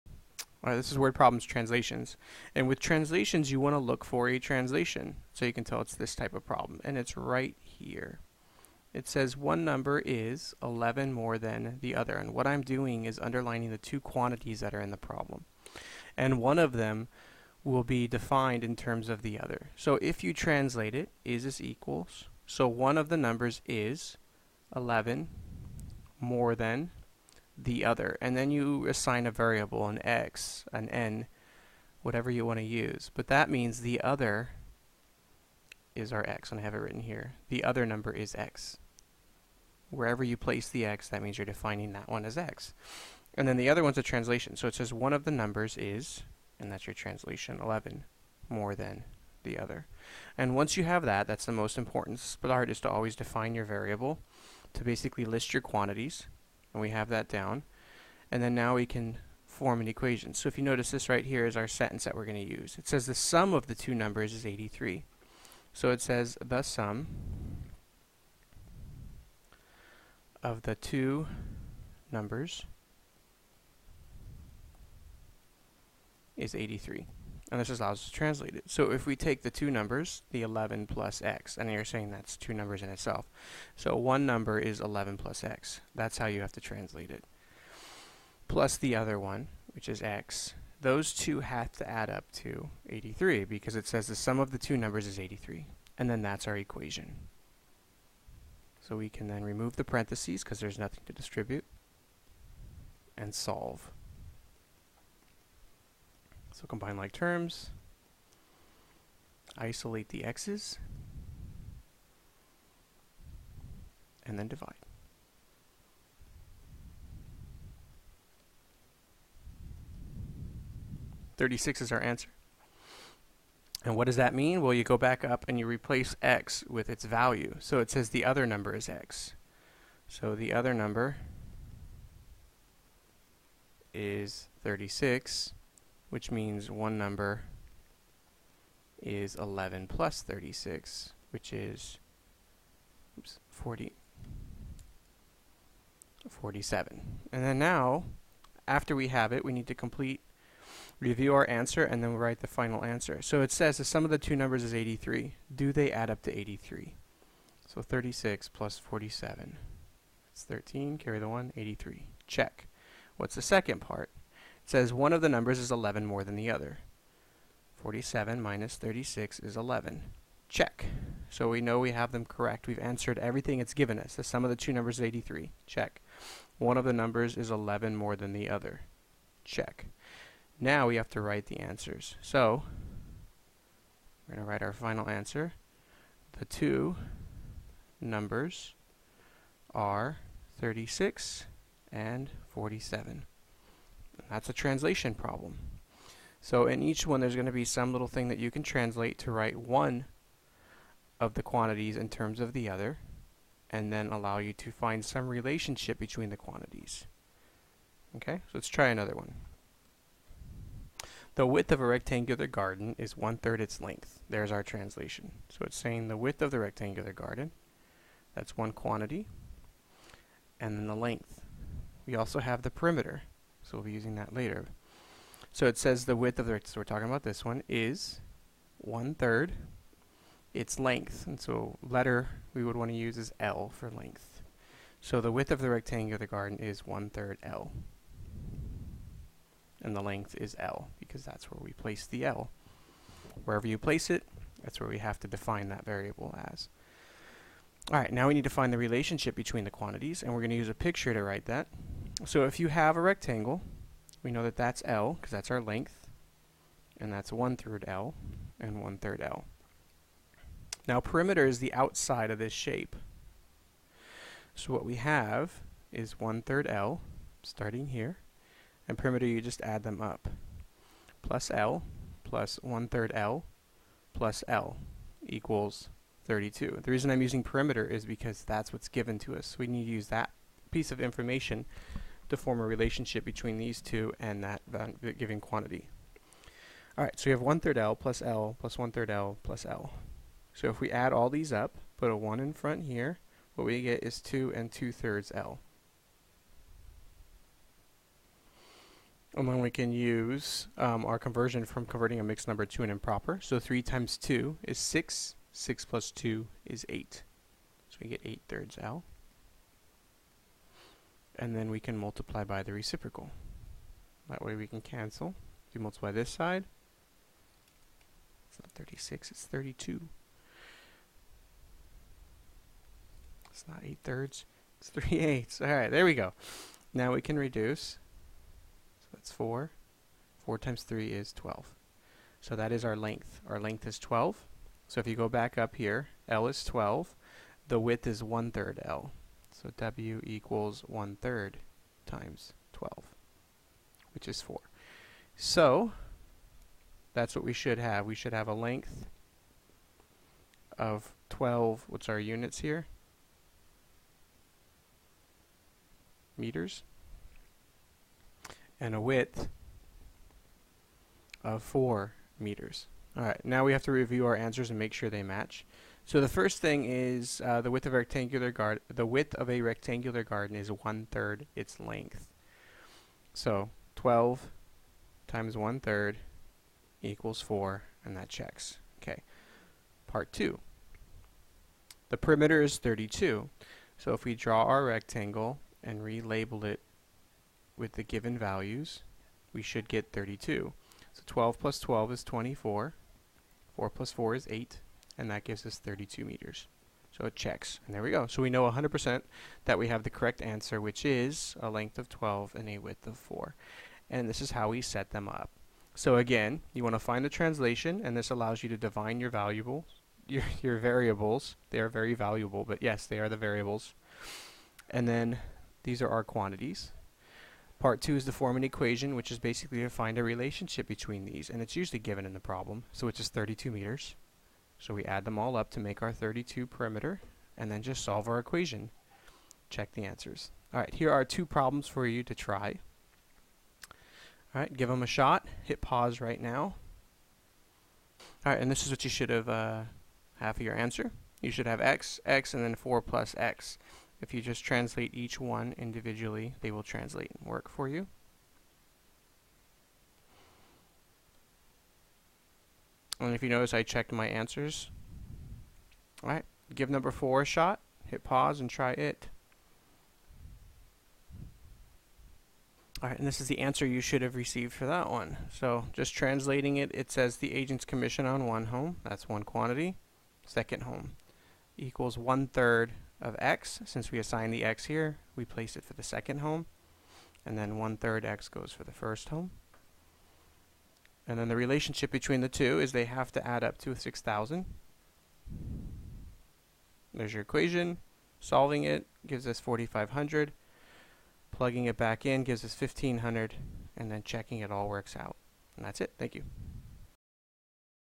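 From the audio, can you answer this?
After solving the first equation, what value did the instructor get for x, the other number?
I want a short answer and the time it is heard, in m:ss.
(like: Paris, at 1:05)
36, at 2:01.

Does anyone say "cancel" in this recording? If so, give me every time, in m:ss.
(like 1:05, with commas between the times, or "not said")
5:14.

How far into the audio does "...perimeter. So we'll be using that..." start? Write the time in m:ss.
3:42.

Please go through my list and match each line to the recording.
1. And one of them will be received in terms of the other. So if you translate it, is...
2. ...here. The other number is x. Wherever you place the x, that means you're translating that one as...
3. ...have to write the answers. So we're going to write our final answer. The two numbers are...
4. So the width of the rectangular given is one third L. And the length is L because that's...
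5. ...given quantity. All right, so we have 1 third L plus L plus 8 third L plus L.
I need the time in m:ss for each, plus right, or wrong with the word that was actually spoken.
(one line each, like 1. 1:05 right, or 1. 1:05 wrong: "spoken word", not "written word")
1. 0:16 wrong: "defined", not "received"
2. 0:37 wrong: "defining", not "translating"
3. 3:00 right
4. 3:54 wrong: "garden", not "given"
5. 4:45 wrong: "1", not "8".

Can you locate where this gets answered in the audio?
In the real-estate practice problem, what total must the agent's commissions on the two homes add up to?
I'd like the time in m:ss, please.
8:03.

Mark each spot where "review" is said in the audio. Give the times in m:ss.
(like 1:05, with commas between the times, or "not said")
2:30, 6:03.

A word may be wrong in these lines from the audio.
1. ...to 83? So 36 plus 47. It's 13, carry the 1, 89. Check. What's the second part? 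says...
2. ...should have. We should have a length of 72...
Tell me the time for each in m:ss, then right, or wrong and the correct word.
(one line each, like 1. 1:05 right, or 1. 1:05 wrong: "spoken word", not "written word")
1. 2:36 wrong: "83", not "89"
2. 5:47 wrong: "12", not "72".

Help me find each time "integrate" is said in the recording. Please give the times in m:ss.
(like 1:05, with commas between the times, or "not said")
not said.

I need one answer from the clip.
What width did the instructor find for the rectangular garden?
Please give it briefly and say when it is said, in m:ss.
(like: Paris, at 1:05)
4 meters, at 6:01.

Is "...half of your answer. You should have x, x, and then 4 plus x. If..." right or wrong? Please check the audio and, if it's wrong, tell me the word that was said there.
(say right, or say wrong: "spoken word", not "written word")
right.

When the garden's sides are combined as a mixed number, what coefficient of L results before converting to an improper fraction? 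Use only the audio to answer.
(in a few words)
2 and 2/3.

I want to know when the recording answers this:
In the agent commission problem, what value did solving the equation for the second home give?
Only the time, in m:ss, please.
8:09.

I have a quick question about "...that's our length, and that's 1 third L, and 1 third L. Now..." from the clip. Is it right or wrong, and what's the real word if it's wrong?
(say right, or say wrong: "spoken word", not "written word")
right.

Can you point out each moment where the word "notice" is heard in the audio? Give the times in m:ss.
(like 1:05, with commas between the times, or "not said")
1:00, 7:33.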